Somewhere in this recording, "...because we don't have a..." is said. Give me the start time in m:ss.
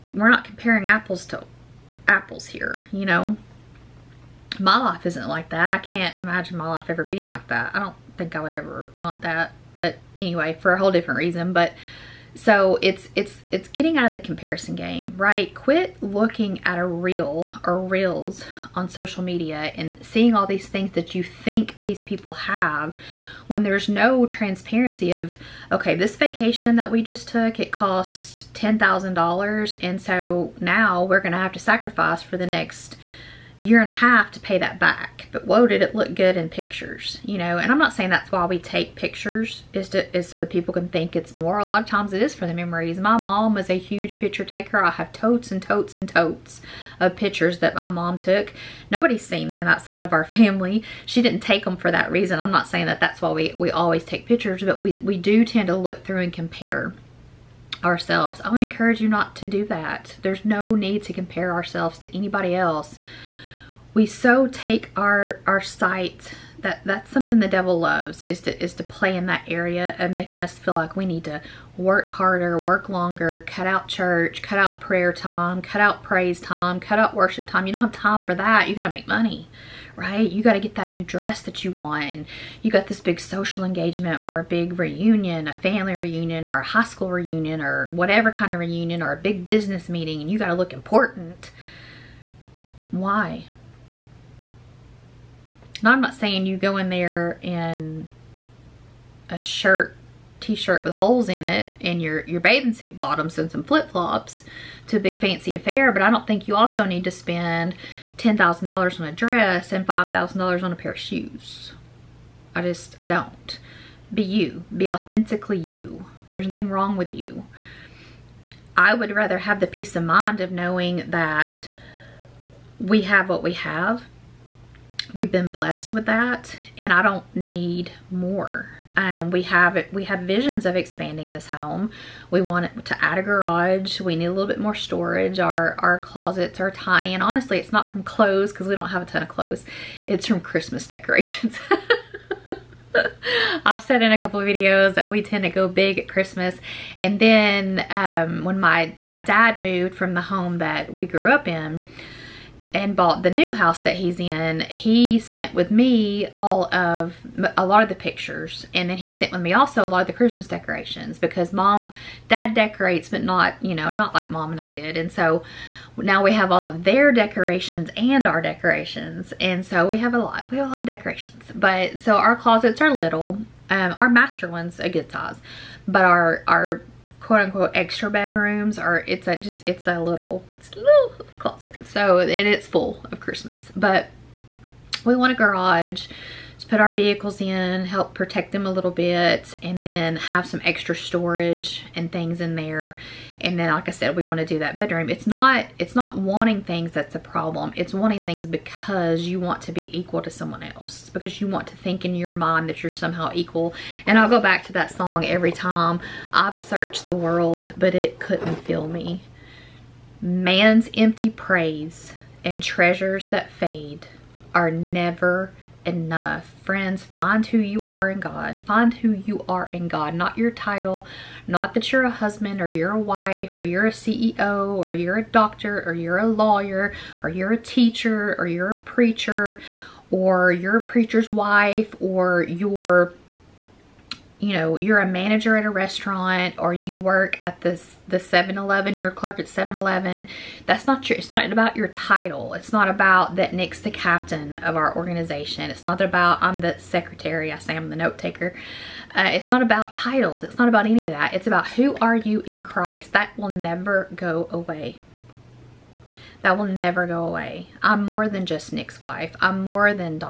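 2:18.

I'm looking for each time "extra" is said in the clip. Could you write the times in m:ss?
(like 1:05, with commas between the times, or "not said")
2:57, 3:10.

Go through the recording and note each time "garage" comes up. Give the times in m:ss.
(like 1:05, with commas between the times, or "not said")
2:13, 3:05.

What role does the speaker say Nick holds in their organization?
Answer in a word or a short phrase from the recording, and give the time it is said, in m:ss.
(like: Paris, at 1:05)
captain, at 4:03.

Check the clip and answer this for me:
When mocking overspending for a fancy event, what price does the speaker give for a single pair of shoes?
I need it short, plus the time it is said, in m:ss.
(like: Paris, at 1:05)
$5,000, at 1:49.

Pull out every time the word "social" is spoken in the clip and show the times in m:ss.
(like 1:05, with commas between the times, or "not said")
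0:18, 1:23.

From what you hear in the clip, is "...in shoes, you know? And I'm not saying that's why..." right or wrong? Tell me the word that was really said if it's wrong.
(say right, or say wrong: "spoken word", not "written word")
wrong: "pictures", not "shoes".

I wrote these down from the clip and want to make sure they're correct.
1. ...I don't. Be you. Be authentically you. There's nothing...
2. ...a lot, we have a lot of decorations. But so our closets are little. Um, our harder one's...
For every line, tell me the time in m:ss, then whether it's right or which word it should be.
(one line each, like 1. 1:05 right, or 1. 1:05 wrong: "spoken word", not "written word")
1. 1:53 right
2. 2:50 wrong: "master", not "harder".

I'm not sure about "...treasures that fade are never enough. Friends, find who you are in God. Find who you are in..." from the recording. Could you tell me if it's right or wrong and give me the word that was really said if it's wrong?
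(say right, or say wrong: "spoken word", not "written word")
right.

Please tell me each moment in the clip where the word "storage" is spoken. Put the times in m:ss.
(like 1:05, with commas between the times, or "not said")
2:14, 3:10.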